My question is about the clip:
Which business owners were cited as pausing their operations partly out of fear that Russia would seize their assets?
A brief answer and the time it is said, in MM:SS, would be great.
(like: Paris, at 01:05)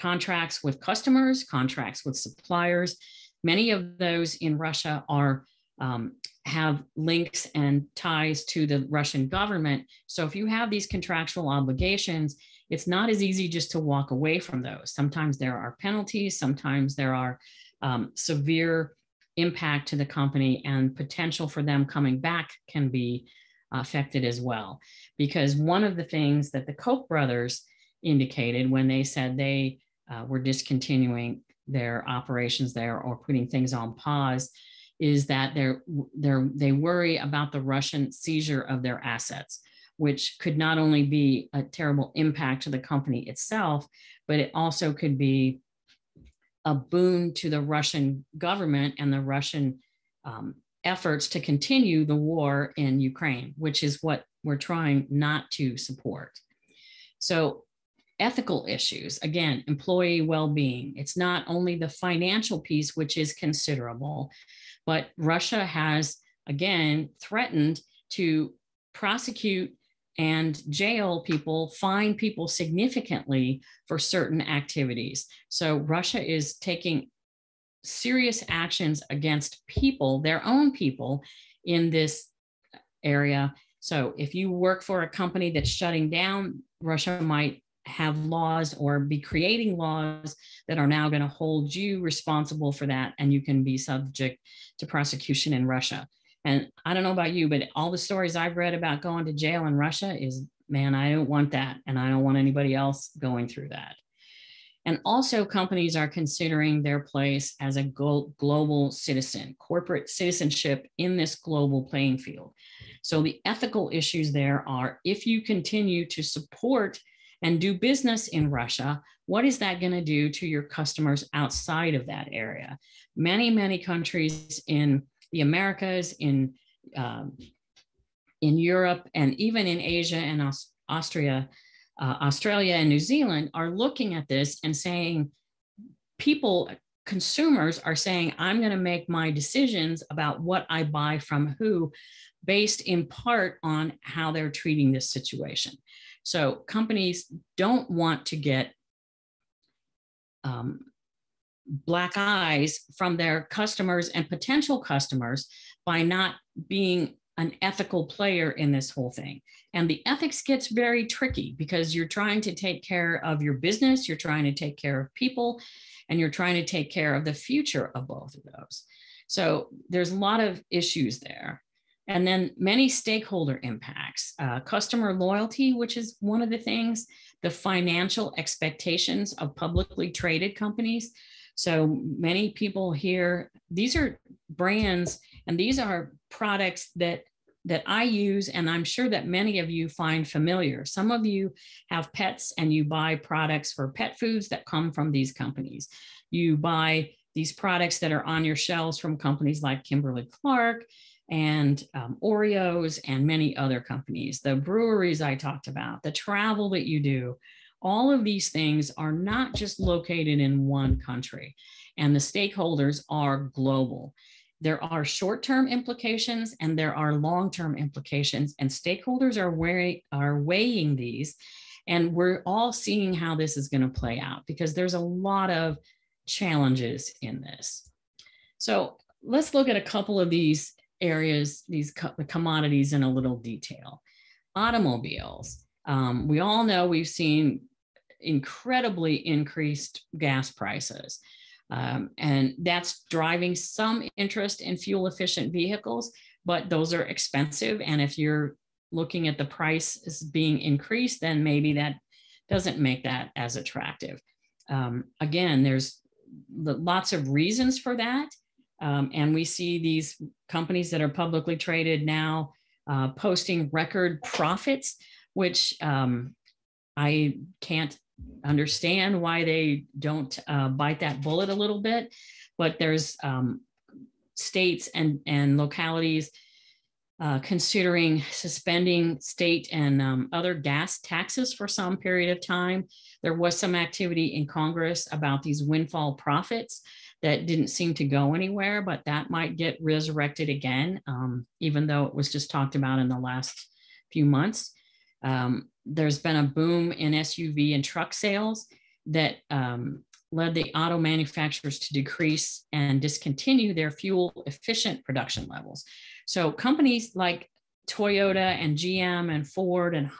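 Koch brothers, at 00:26.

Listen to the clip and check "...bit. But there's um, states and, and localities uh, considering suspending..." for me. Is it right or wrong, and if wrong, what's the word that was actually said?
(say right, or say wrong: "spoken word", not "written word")
right.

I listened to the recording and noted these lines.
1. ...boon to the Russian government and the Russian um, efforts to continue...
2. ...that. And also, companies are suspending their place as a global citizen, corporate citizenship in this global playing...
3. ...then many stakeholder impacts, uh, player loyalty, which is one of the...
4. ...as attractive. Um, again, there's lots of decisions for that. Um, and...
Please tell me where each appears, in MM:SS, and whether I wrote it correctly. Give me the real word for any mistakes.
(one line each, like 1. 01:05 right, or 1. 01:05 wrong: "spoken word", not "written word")
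1. 00:46 right
2. 01:43 wrong: "considering", not "suspending"
3. 02:52 wrong: "customer", not "player"
4. 04:13 wrong: "reasons", not "decisions".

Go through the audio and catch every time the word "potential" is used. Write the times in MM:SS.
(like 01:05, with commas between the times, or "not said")
00:20, 02:34.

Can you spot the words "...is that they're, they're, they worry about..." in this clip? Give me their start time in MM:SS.
00:34.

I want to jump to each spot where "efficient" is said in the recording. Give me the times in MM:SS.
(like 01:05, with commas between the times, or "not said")
04:05, 05:04.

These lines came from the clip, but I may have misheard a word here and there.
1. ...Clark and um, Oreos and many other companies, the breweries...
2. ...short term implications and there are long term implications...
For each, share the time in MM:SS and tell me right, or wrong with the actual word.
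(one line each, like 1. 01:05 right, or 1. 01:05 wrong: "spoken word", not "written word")
1. 03:20 right
2. 03:35 right.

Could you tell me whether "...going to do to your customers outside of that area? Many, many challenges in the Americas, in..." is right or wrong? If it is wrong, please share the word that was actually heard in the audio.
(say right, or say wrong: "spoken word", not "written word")
wrong: "countries", not "challenges".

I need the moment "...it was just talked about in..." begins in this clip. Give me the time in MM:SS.
04:52.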